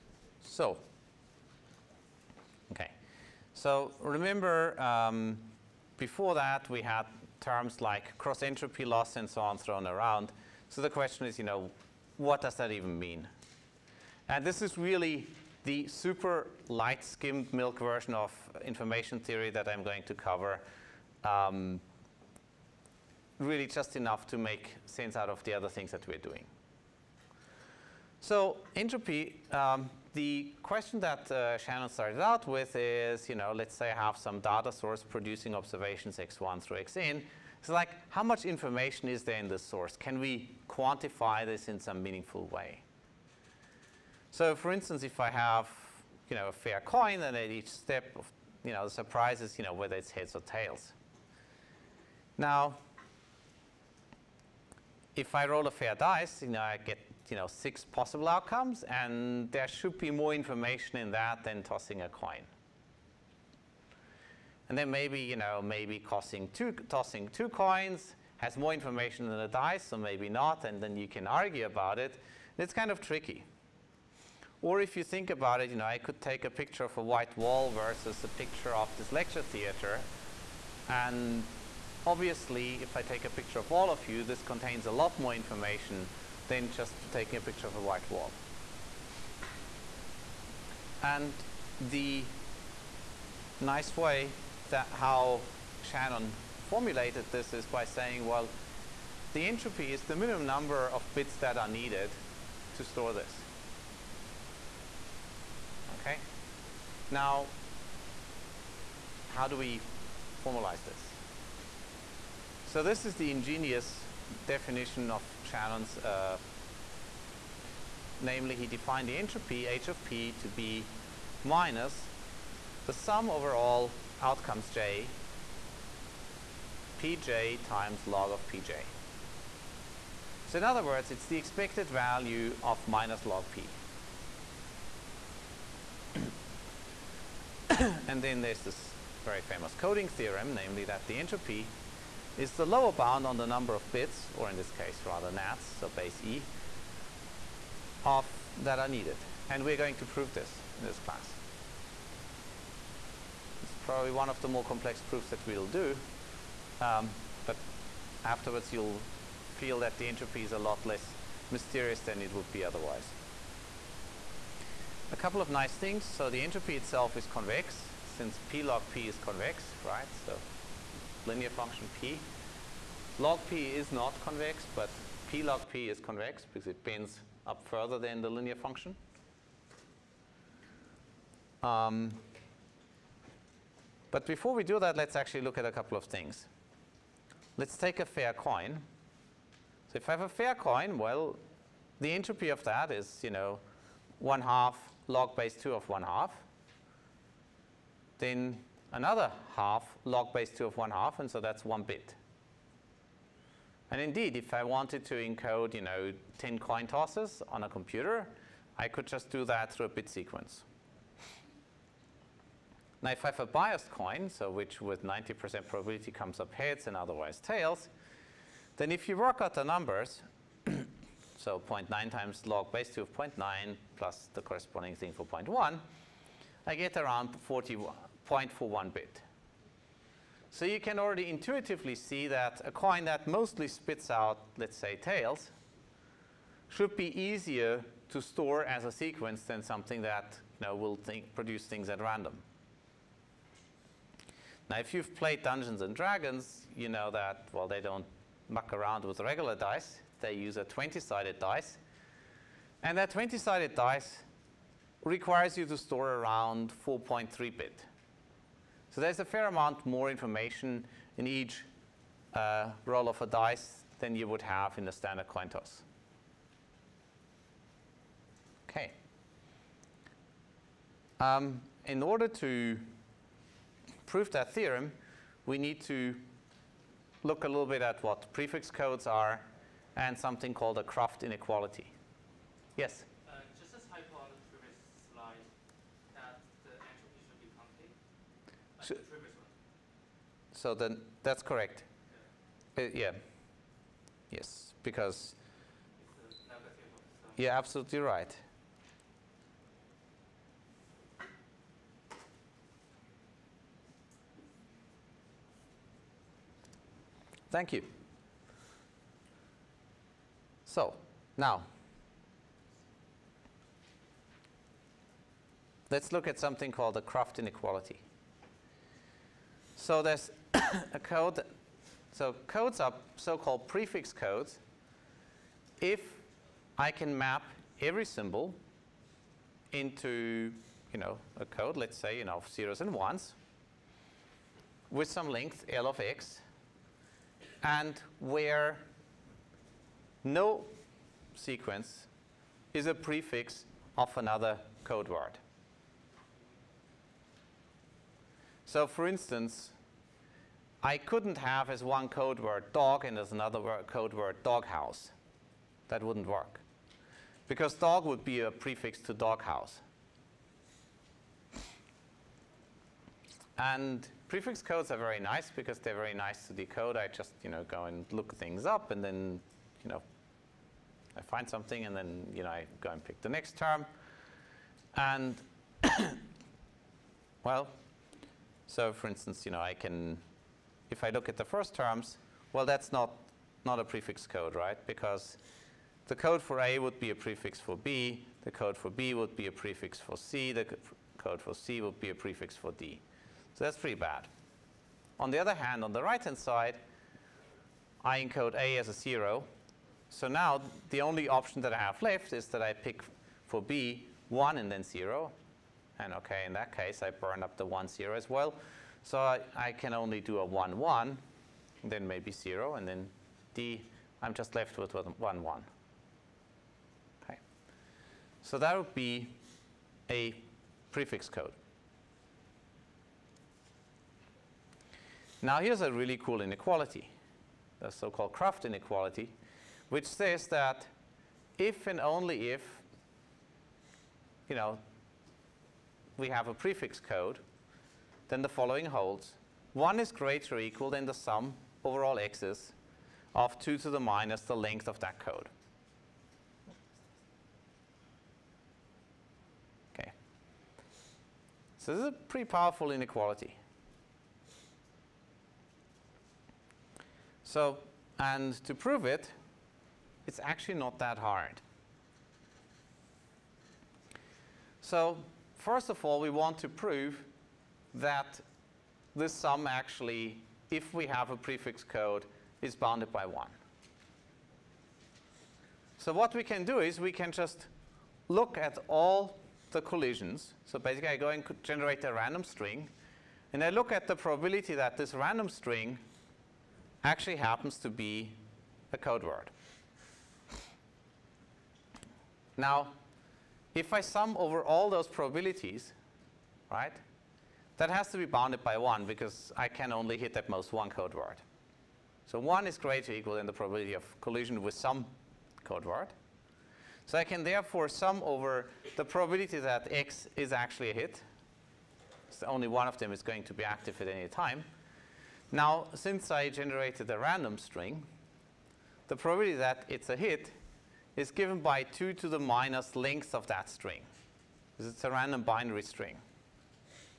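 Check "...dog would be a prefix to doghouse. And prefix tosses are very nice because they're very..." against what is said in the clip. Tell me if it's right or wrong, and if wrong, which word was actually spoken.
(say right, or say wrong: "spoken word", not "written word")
wrong: "codes", not "tosses".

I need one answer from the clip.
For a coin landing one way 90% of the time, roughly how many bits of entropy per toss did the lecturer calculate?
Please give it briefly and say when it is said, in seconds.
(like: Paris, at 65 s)
0.41, at 228 s.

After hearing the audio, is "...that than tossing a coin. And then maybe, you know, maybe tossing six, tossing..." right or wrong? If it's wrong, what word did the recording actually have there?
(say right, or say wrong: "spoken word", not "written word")
wrong: "two", not "six".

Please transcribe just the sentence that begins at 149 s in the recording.
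And we're going to prove this in this class.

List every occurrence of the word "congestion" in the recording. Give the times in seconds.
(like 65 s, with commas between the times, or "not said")
not said.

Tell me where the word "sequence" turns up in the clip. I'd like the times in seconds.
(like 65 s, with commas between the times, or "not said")
210 s, 238 s, 341 s.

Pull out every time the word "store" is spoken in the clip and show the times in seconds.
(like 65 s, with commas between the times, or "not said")
102 s, 238 s, 255 s.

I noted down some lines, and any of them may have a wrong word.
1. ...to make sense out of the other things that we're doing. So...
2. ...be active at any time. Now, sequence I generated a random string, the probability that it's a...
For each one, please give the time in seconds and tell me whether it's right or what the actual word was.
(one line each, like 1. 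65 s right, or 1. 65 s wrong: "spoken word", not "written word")
1. 24 s right
2. 513 s wrong: "since", not "sequence".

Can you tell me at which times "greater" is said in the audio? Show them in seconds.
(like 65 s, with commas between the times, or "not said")
440 s, 502 s.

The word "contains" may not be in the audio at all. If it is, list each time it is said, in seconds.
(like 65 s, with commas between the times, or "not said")
84 s.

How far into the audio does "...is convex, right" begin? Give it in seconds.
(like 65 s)
169 s.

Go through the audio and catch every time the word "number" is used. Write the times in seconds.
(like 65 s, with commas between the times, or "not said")
100 s, 143 s, 219 s.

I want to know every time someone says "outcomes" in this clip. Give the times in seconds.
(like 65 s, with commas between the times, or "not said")
58 s, 124 s.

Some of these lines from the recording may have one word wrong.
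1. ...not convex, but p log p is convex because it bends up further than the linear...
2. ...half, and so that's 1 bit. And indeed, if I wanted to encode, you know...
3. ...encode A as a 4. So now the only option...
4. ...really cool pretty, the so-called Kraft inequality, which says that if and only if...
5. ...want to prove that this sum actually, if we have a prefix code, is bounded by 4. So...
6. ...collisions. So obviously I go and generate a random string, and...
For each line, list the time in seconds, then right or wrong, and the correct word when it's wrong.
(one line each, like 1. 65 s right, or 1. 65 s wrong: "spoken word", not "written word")
1. 173 s right
2. 200 s right
3. 398 s wrong: "0", not "4"
4. 425 s wrong: "inequality", not "pretty"
5. 466 s wrong: "1", not "4"
6. 479 s wrong: "basically", not "obviously".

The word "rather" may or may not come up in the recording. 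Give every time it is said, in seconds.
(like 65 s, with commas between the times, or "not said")
145 s.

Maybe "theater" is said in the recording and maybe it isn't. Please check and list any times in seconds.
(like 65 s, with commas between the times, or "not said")
79 s.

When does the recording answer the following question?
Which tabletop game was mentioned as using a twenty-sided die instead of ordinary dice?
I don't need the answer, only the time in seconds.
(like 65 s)
245 s.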